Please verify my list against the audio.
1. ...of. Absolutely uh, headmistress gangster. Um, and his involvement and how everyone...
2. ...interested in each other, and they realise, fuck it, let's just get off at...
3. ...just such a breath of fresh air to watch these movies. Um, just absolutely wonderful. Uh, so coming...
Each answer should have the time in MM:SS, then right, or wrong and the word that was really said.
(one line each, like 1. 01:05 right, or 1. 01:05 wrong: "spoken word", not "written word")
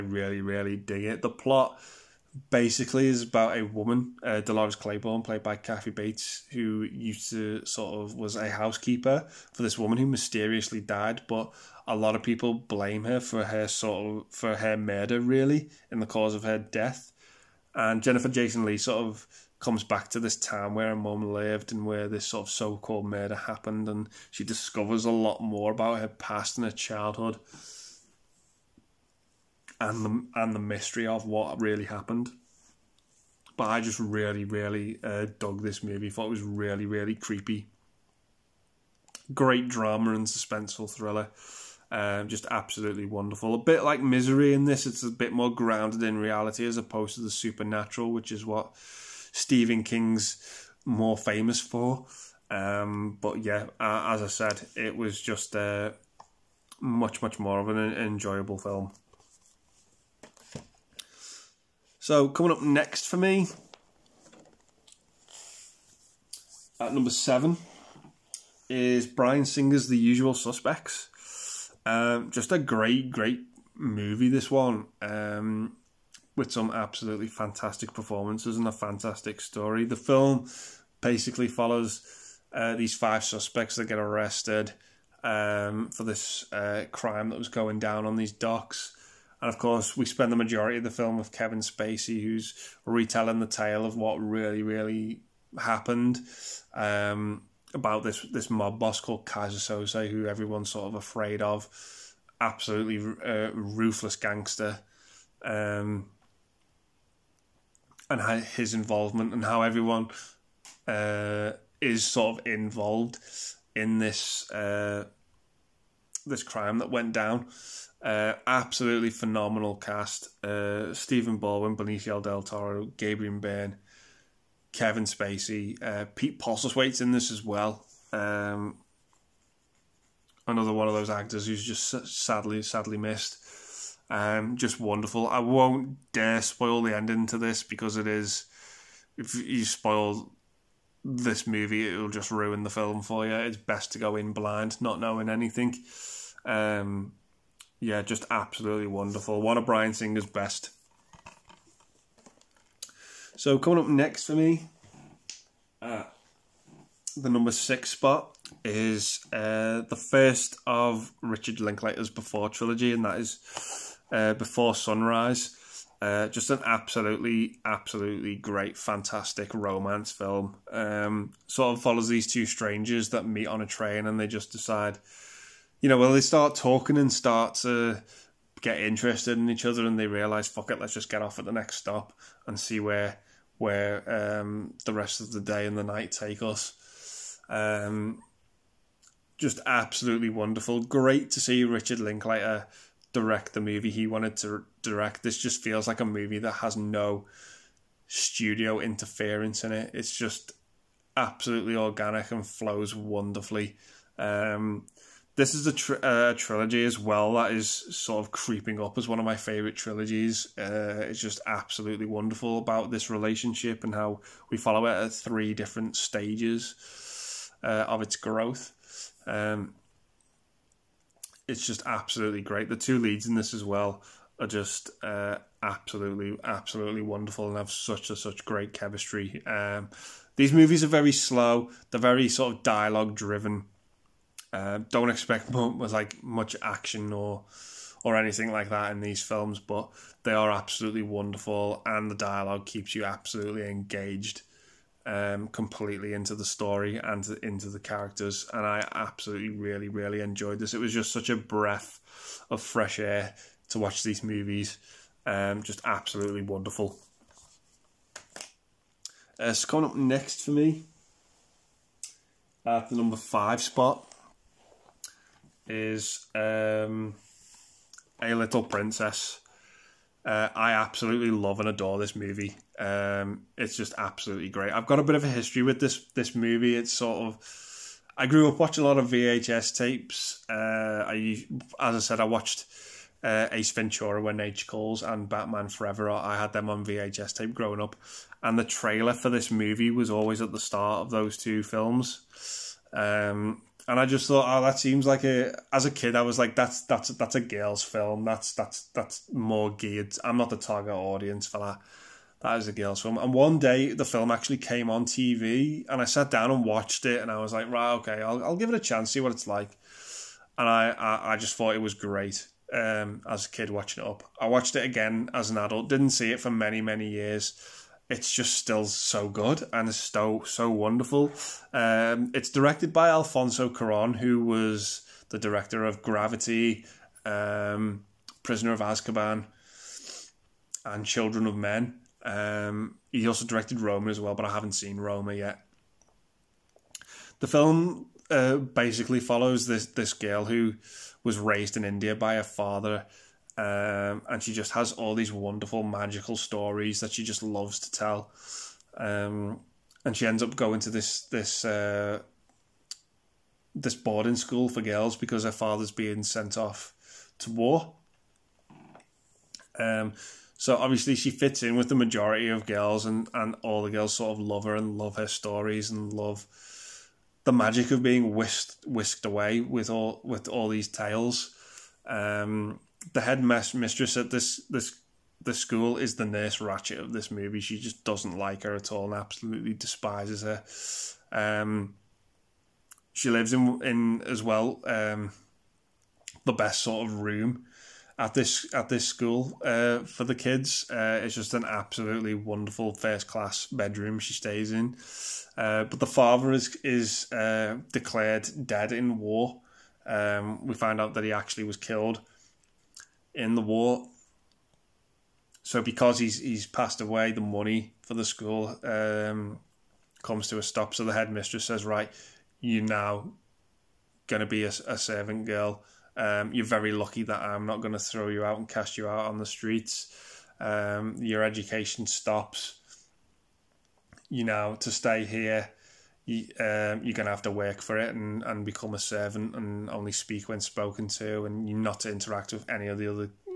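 1. 01:41 wrong: "ruthless", not "headmistress"
2. 02:58 right
3. 04:10 right.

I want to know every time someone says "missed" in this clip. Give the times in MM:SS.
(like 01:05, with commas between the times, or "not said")
02:12.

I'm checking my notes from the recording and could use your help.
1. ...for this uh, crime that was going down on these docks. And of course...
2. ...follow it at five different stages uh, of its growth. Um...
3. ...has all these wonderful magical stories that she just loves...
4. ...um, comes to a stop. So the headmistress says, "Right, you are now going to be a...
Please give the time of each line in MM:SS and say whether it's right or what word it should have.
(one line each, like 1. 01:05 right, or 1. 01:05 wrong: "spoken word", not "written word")
1. 01:25 right
2. 03:34 wrong: "three", not "five"
3. 05:44 right
4. 06:48 right.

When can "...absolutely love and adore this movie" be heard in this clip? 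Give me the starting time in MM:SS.
04:30.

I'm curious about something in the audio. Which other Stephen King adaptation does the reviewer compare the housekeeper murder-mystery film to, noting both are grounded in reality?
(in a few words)
Misery.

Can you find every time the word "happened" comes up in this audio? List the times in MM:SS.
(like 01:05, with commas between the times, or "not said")
00:23, 00:31, 01:35.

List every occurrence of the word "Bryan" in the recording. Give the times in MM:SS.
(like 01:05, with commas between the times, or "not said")
01:09, 02:29.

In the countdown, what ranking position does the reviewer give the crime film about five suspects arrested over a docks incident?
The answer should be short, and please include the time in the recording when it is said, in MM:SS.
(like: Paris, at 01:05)
7, at 01:07.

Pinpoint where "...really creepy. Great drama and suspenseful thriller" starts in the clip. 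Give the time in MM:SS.
00:36.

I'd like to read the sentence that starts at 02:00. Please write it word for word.
Uh, Stephen Baldwin, Benicio del Toro, Gabriel Byrne, Kevin Spacey, uh, Pete Postlethwaite's in this as well.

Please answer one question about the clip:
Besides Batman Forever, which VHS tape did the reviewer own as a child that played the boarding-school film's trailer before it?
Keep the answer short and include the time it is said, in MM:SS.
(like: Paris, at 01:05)
Ace Ventura: When Nature Calls, at 04:43.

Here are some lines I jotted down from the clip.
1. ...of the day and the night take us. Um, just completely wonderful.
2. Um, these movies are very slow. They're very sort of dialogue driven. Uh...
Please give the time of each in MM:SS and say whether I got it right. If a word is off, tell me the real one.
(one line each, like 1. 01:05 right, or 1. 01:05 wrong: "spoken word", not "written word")
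1. 03:05 wrong: "absolutely", not "completely"
2. 03:49 right.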